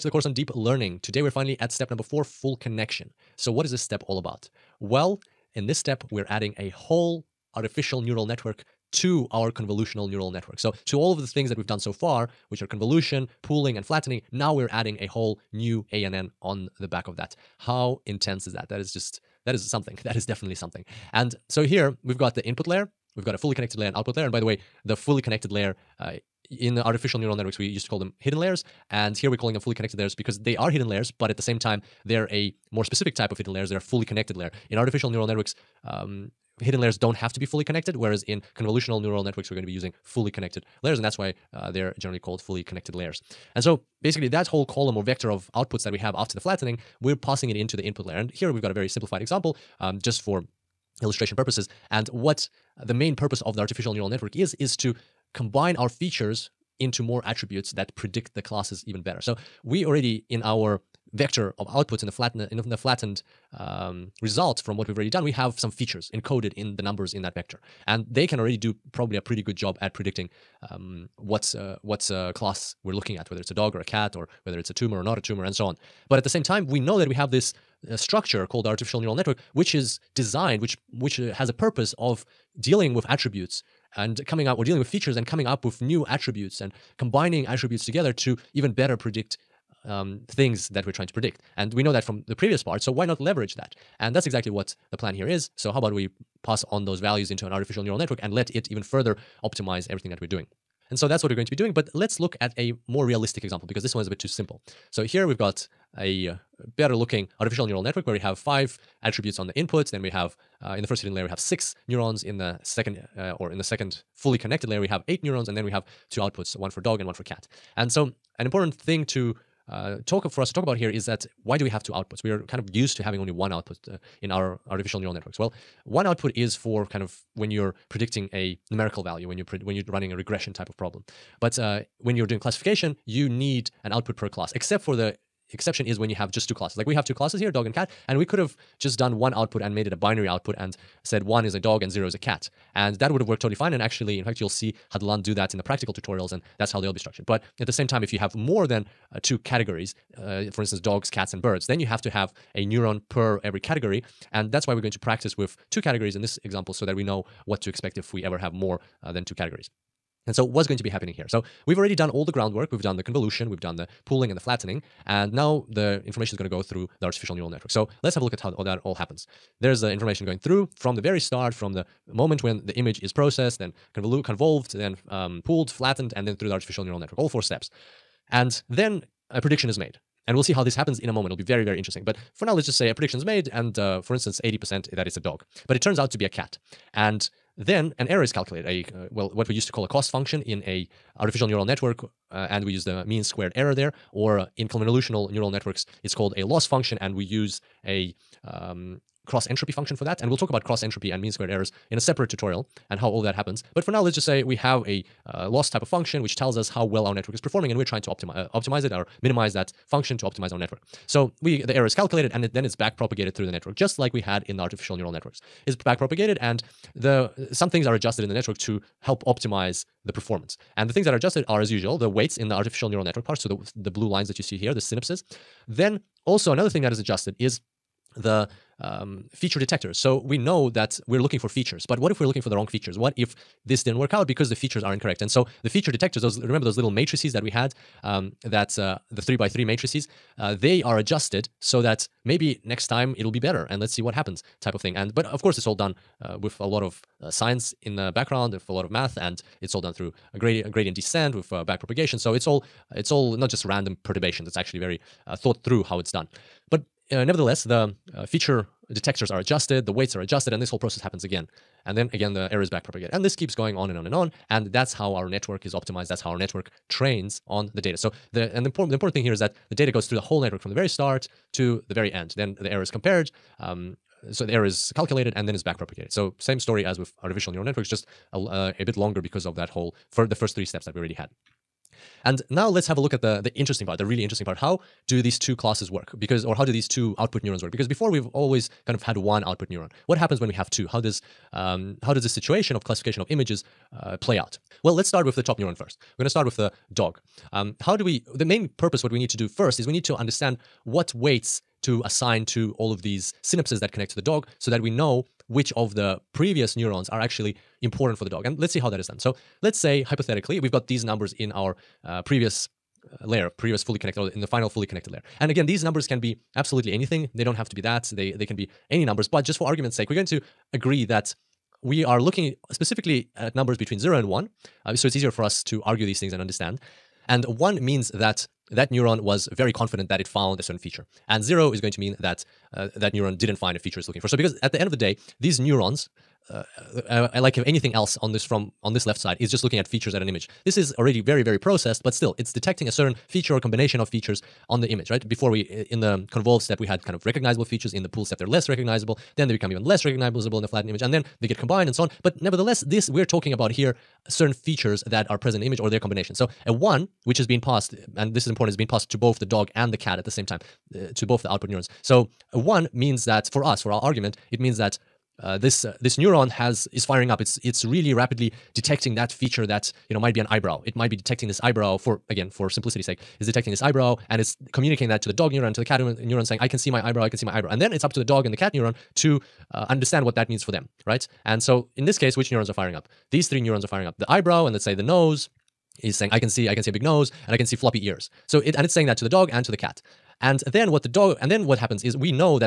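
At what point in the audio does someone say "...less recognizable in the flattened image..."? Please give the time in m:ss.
5:49.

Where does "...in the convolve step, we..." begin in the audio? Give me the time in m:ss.
5:45.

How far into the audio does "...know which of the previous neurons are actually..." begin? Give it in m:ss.
5:04.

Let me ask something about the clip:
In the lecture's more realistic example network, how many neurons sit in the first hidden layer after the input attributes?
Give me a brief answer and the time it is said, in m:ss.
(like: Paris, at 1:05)
6, at 1:51.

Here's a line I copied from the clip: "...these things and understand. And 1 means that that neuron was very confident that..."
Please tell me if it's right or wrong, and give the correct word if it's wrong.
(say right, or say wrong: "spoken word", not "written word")
right.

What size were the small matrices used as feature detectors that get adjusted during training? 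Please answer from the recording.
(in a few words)
3 by 3.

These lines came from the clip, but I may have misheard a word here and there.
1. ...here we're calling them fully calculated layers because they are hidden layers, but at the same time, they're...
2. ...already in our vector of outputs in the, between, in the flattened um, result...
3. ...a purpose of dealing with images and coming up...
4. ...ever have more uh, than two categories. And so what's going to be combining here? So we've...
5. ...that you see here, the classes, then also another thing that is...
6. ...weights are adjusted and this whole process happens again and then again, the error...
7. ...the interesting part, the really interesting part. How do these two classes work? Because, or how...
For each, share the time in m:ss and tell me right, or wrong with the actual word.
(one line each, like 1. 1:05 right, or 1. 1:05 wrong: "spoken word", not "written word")
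1. 0:29 wrong: "connected", not "calculated"
2. 0:59 wrong: "flatten", not "between"
3. 1:21 wrong: "attributes", not "images"
4. 2:38 wrong: "happening", not "combining"
5. 3:44 wrong: "synapses", not "classes"
6. 4:19 right
7. 4:43 right.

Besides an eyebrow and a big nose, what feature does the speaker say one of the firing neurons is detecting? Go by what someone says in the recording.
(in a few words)
Floppy ears.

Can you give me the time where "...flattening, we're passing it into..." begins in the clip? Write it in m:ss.
0:46.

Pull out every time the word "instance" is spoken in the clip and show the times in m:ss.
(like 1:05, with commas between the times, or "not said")
2:30, 3:04.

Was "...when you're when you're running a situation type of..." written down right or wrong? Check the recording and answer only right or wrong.
wrong.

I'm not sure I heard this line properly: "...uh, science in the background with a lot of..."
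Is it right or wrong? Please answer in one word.
right.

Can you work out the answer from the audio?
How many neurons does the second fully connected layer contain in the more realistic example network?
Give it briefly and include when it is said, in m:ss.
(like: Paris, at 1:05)
8, at 1:55.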